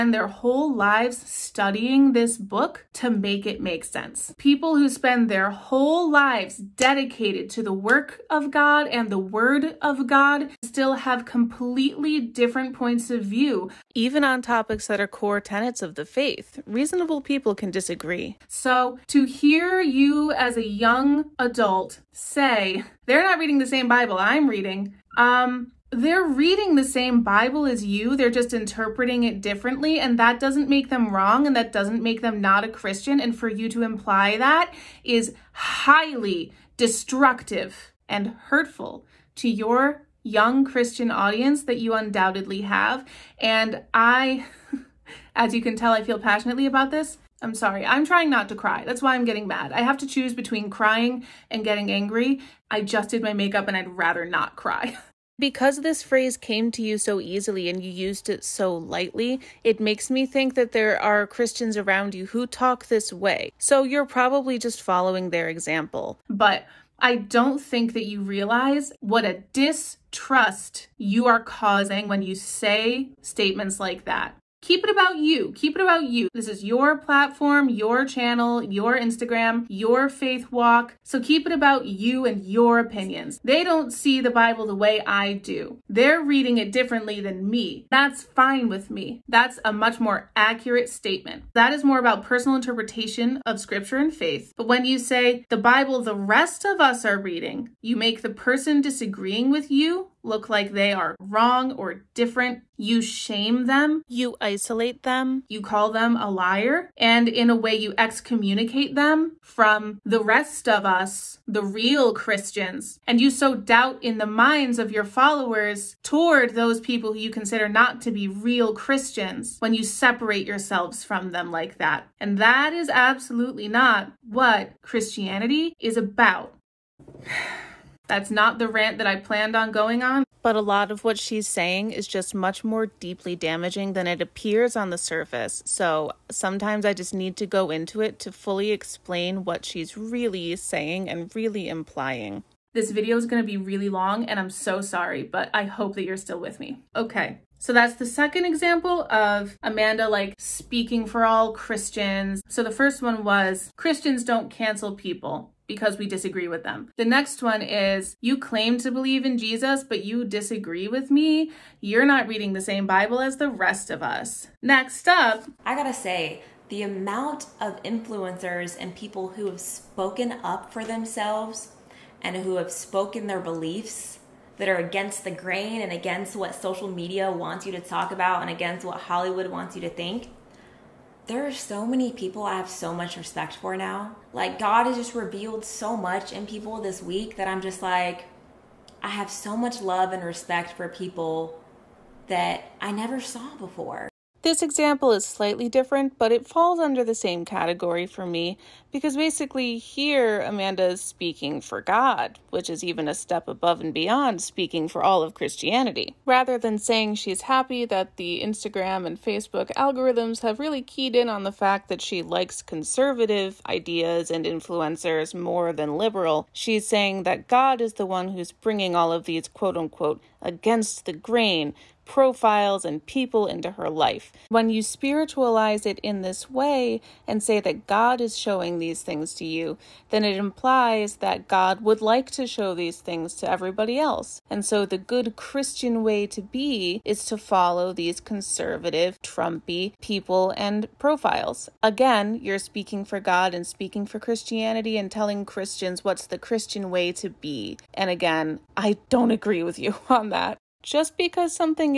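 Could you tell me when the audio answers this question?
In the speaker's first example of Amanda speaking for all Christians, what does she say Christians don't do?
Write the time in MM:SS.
02:34.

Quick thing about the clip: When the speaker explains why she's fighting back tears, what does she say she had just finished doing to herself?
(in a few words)
did my makeup.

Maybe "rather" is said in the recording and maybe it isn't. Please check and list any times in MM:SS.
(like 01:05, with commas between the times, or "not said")
00:53, 03:26.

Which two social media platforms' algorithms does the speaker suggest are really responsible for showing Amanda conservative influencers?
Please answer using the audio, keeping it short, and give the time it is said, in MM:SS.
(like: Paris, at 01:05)
Instagram and Facebook, at 03:28.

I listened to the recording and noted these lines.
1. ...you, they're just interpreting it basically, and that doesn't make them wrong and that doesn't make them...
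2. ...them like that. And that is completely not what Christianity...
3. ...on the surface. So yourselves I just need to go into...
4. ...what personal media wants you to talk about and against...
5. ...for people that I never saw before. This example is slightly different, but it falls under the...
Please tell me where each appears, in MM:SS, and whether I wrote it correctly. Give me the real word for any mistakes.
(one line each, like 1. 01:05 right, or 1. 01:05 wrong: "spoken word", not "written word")
1. 00:27 wrong: "differently", not "basically"
2. 02:01 wrong: "absolutely", not "completely"
3. 02:14 wrong: "sometimes", not "yourselves"
4. 02:56 wrong: "social", not "personal"
5. 03:10 right.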